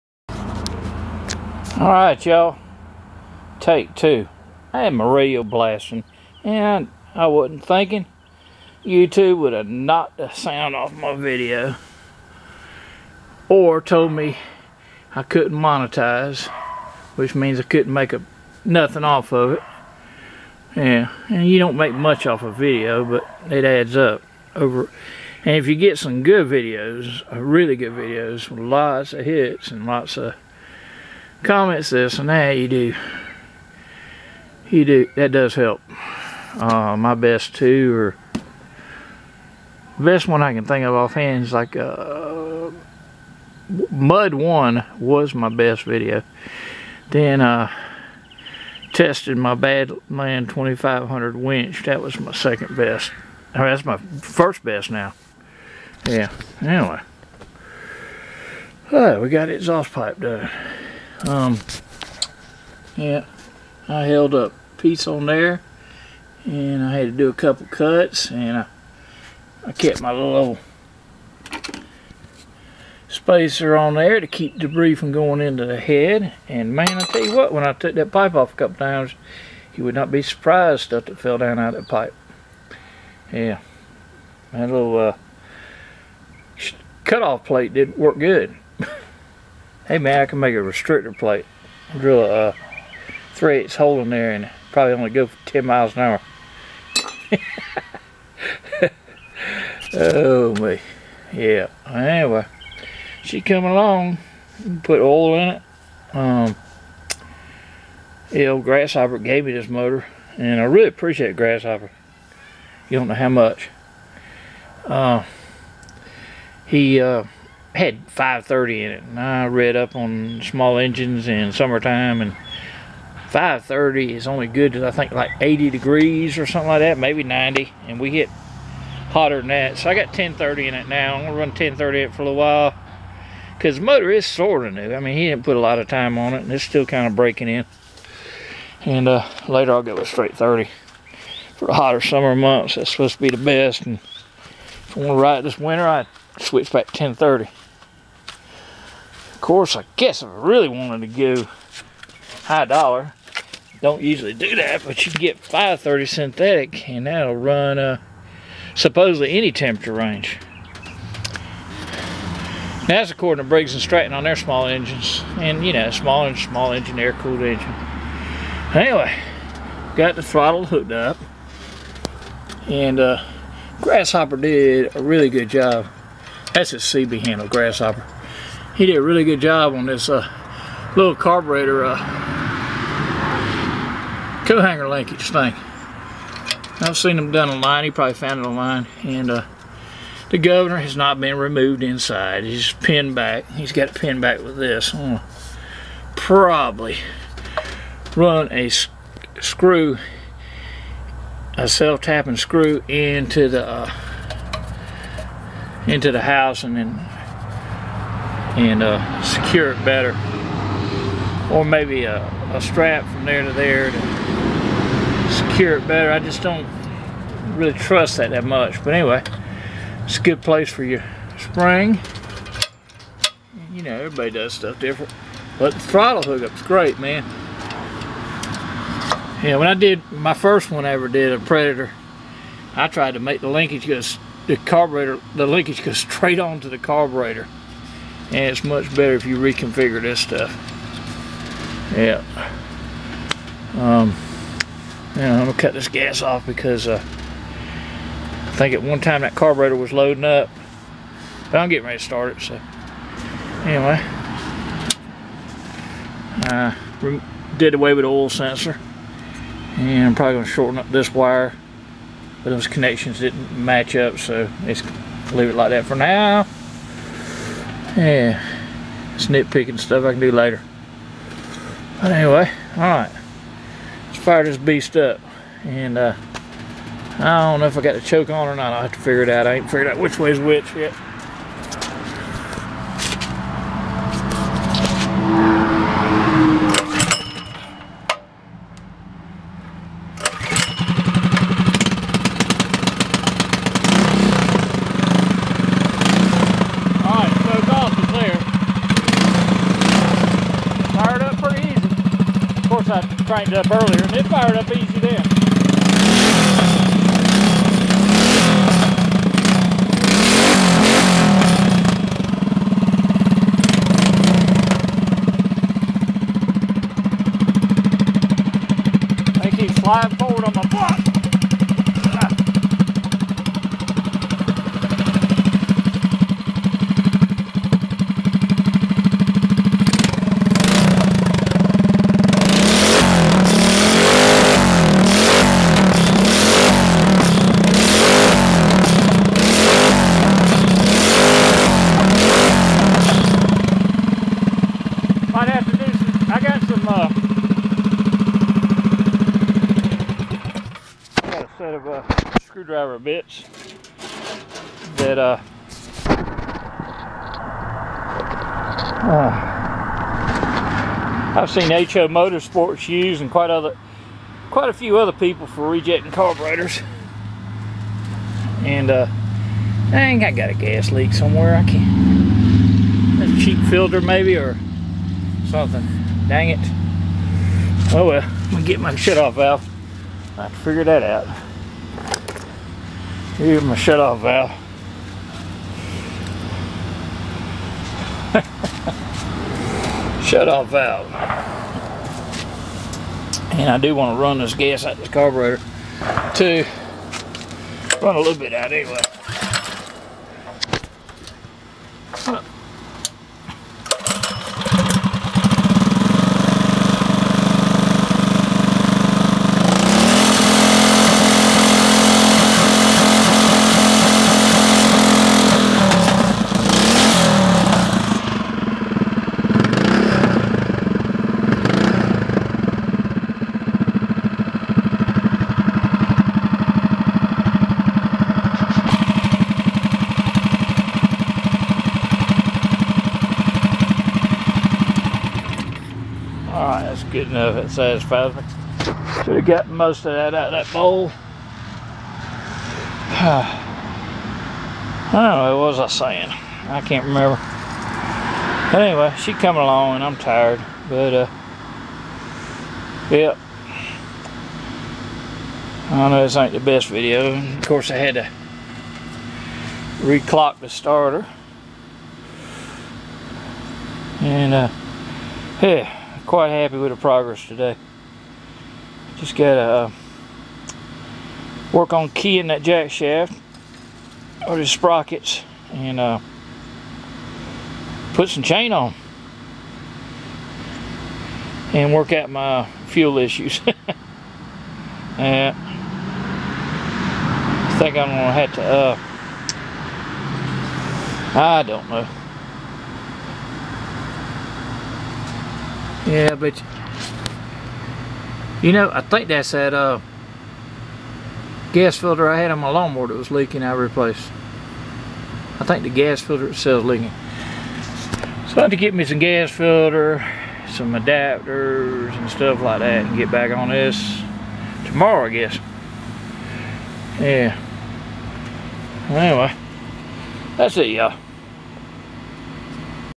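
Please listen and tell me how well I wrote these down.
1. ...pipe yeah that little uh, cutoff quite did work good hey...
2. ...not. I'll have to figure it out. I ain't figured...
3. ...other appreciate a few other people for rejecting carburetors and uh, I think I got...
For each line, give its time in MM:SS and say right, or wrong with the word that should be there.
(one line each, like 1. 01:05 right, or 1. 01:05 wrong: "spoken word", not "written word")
1. 01:21 wrong: "plate", not "quite"
2. 04:38 right
3. 06:03 wrong: "quite", not "appreciate".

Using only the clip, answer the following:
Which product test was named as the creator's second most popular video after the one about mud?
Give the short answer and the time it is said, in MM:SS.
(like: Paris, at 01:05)
Badland 2500 winch, at 00:49.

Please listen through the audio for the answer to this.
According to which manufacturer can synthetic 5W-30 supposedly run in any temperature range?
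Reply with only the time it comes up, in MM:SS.
02:43.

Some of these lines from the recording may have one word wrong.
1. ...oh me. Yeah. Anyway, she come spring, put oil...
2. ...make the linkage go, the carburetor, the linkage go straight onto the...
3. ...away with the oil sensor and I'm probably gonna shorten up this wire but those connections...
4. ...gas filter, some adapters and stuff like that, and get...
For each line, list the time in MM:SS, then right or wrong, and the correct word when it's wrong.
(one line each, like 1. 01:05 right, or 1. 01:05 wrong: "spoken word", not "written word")
1. 01:39 wrong: "along", not "spring"
2. 03:53 right
3. 04:17 right
4. 08:29 right.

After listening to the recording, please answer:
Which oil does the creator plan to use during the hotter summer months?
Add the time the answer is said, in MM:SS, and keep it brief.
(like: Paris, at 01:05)
straight 30, at 02:20.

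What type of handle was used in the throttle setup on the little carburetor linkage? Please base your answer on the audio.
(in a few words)
CB handle.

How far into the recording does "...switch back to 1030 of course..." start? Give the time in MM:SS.
02:26.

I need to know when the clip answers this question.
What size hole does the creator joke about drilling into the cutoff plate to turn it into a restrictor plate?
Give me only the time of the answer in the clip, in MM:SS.
01:33.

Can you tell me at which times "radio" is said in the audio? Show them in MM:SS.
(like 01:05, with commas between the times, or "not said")
00:05.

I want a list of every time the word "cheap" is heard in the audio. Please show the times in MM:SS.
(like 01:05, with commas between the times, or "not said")
06:13.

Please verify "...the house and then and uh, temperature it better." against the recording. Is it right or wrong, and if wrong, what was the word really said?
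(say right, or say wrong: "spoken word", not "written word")
wrong: "secure", not "temperature".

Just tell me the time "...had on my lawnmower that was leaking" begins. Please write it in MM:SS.
08:22.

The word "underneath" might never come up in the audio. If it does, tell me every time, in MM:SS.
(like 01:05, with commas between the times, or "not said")
not said.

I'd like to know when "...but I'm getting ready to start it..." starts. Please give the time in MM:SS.
04:11.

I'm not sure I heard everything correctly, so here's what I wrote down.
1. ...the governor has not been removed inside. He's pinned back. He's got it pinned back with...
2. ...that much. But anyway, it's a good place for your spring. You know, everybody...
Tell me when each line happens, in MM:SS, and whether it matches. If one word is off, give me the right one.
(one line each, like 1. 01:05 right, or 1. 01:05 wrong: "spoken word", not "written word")
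1. 03:10 right
2. 03:38 right.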